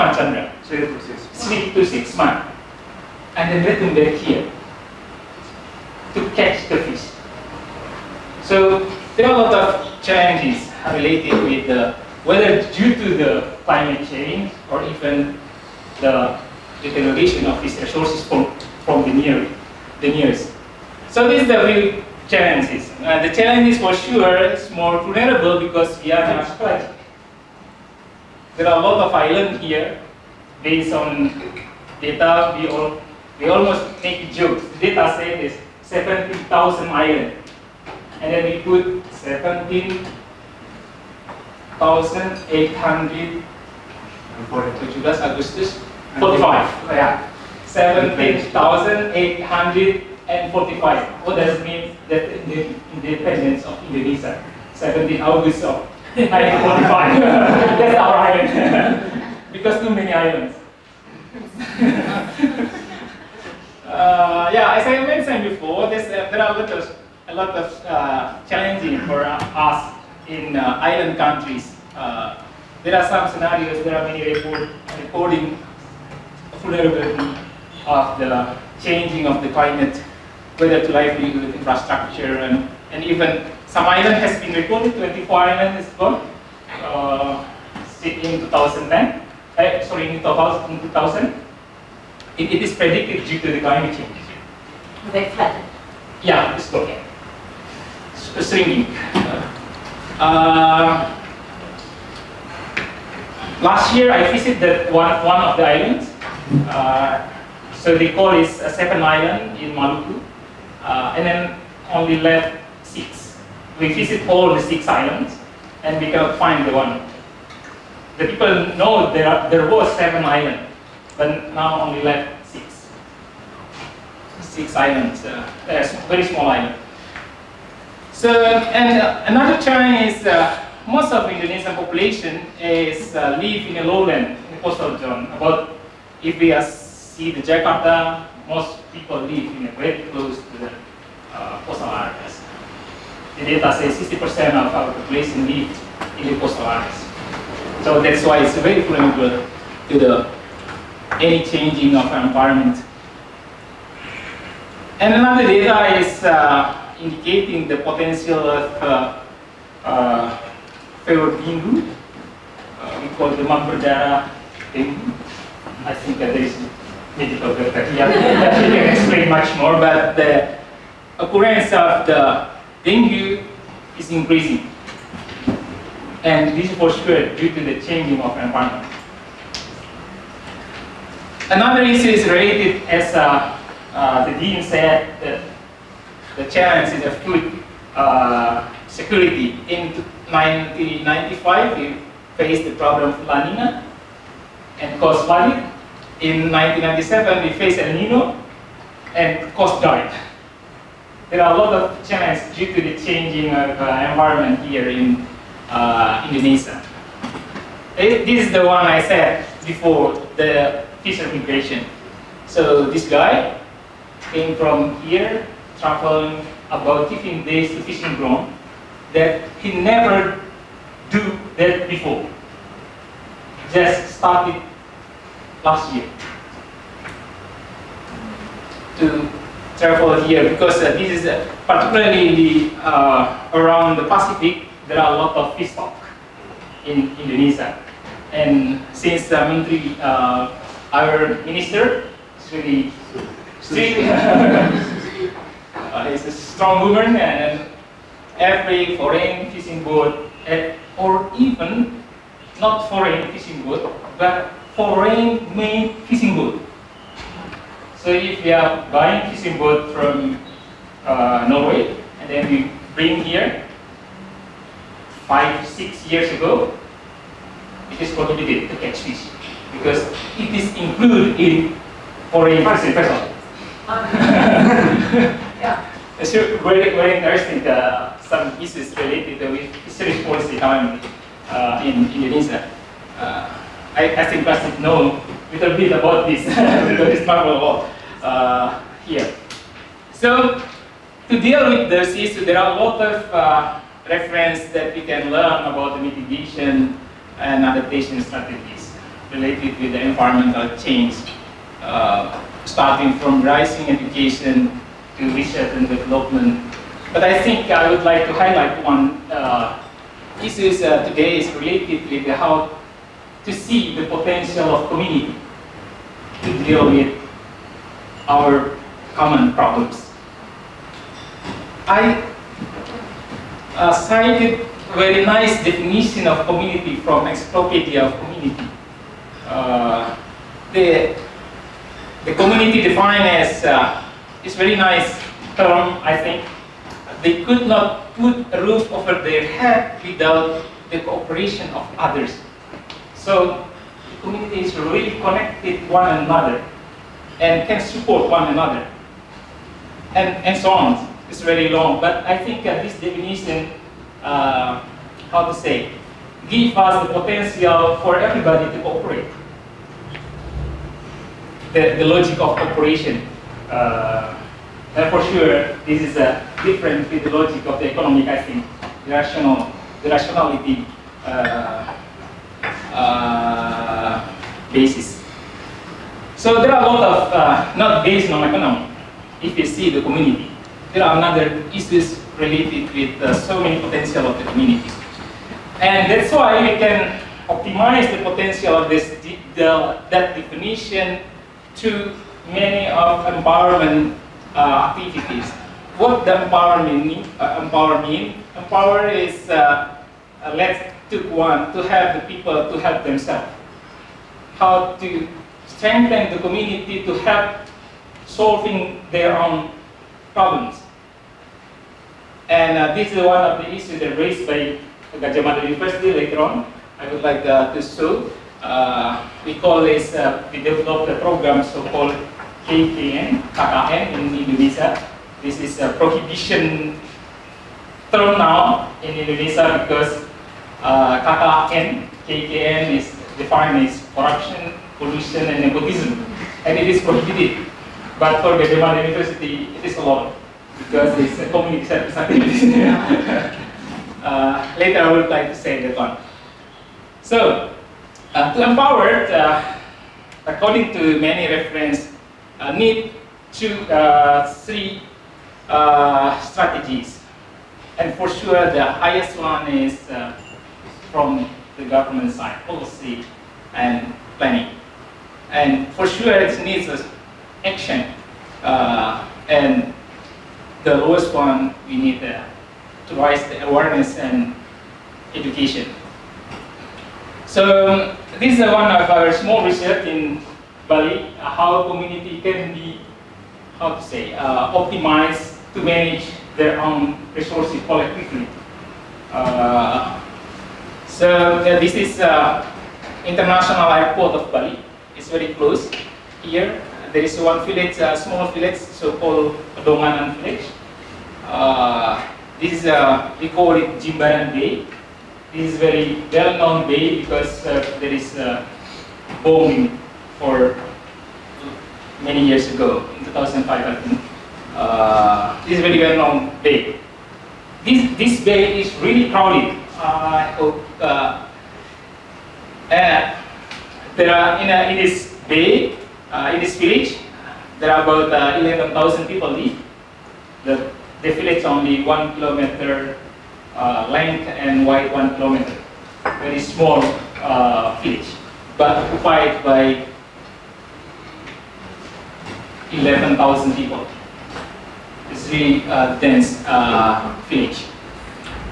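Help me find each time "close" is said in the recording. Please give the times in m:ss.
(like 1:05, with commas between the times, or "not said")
2:20, 8:15.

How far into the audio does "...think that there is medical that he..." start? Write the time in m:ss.
2:45.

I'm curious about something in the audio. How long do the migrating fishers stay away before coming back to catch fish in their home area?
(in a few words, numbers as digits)
3 to 6 months.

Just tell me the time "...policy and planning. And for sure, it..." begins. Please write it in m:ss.
7:42.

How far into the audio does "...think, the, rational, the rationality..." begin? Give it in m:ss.
6:08.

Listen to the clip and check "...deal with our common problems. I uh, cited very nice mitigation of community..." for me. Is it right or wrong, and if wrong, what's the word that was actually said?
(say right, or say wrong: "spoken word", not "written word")
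wrong: "definition", not "mitigation".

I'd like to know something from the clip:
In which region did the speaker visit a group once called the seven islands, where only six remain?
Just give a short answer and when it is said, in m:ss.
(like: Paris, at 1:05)
Maluku, at 1:49.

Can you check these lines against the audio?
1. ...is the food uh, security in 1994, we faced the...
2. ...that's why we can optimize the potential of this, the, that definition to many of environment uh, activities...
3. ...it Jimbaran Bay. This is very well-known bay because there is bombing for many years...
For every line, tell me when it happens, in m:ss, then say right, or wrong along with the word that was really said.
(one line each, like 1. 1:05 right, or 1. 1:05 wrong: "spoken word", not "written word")
1. 3:06 wrong: "1995", not "1994"
2. 6:26 right
3. 8:23 right.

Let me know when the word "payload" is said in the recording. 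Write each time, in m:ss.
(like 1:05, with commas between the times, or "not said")
2:41.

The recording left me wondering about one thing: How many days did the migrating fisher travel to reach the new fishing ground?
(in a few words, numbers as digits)
15 days.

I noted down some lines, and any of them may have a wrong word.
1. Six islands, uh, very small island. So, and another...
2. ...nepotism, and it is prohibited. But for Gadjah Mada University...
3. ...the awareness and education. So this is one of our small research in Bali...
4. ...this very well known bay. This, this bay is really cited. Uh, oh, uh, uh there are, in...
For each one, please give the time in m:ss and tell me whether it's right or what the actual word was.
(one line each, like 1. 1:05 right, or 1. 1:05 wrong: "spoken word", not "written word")
1. 2:04 right
2. 7:15 right
3. 7:53 right
4. 8:35 wrong: "crowded", not "cited".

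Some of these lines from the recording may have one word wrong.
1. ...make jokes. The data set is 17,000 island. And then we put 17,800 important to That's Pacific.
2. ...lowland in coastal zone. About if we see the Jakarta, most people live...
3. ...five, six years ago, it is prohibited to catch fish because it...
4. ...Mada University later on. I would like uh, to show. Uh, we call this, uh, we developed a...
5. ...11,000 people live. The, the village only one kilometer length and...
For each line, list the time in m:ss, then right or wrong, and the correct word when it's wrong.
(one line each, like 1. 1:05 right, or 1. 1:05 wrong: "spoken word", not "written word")
1. 0:34 wrong: "Augustus", not "Pacific"
2. 2:13 right
3. 4:25 right
4. 6:55 right
5. 8:48 right.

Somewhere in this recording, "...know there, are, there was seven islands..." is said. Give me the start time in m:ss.
1:58.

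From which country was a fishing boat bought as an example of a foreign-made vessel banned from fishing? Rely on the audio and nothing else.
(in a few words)
Norway.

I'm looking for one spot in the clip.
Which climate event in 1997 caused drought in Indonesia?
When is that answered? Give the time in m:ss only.
3:17.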